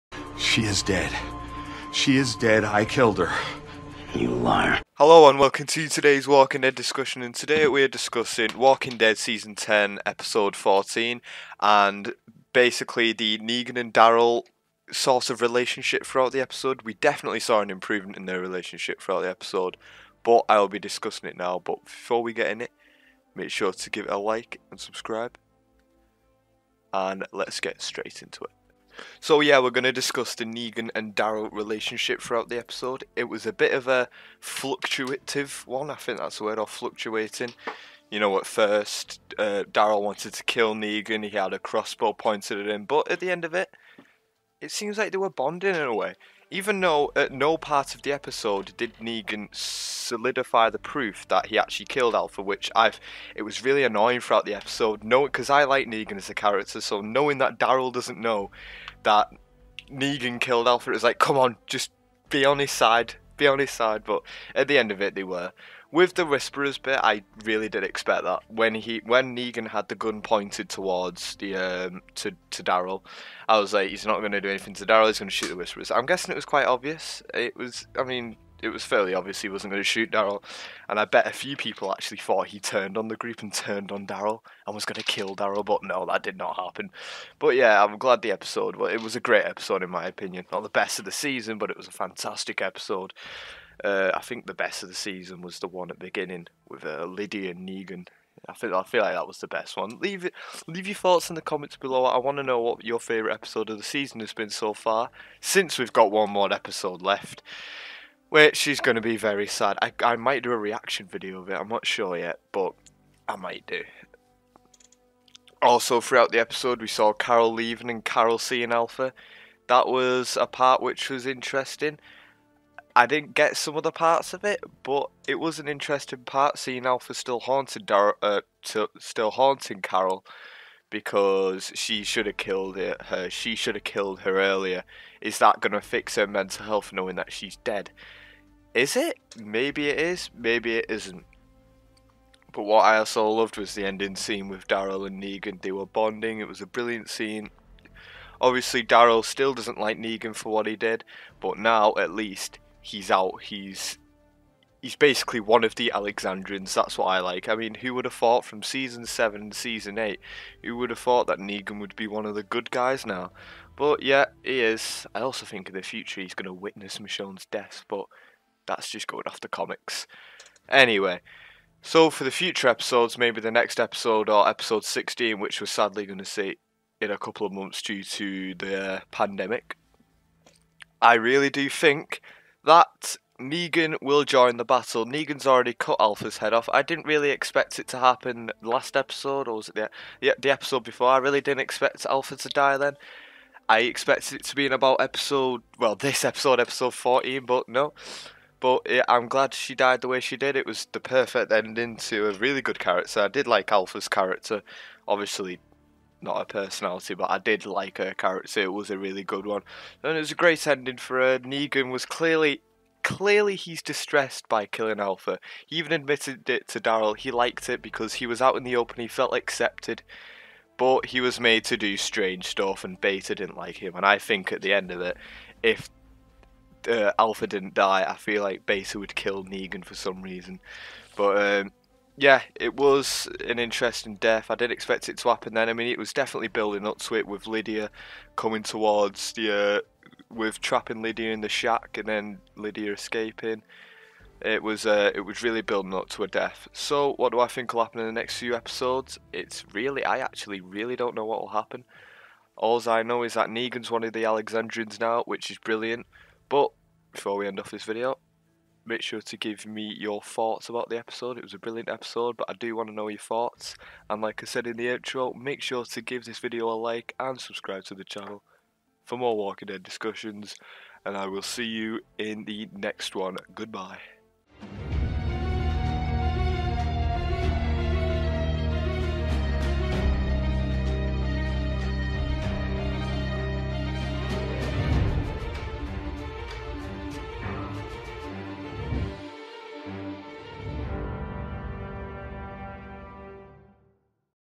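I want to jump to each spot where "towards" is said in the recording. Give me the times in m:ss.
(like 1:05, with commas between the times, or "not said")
1:10, 3:58.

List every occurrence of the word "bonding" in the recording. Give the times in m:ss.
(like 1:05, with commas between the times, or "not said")
0:45, 2:25.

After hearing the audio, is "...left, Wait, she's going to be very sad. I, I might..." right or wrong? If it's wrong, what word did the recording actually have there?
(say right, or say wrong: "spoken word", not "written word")
right.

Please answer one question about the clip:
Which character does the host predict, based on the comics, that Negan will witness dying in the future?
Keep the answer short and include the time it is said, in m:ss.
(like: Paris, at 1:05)
Michonne, at 2:46.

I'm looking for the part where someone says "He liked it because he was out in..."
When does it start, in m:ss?
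3:37.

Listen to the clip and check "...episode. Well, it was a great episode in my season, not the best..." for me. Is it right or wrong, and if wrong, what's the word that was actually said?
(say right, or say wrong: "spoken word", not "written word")
wrong: "opinion", not "season".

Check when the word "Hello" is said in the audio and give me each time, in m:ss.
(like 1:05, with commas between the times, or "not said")
0:04.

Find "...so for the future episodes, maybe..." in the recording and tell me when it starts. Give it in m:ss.
2:51.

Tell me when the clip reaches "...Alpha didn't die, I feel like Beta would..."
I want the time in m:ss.
3:47.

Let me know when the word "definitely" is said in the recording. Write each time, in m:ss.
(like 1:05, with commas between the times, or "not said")
0:16, 3:56.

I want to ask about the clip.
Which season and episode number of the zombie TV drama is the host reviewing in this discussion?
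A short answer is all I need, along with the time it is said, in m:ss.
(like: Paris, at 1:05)
Season 10 Episode 14, at 0:09.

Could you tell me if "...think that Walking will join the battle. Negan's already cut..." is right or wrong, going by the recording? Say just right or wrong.
wrong.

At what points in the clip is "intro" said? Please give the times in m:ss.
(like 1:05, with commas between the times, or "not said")
4:24.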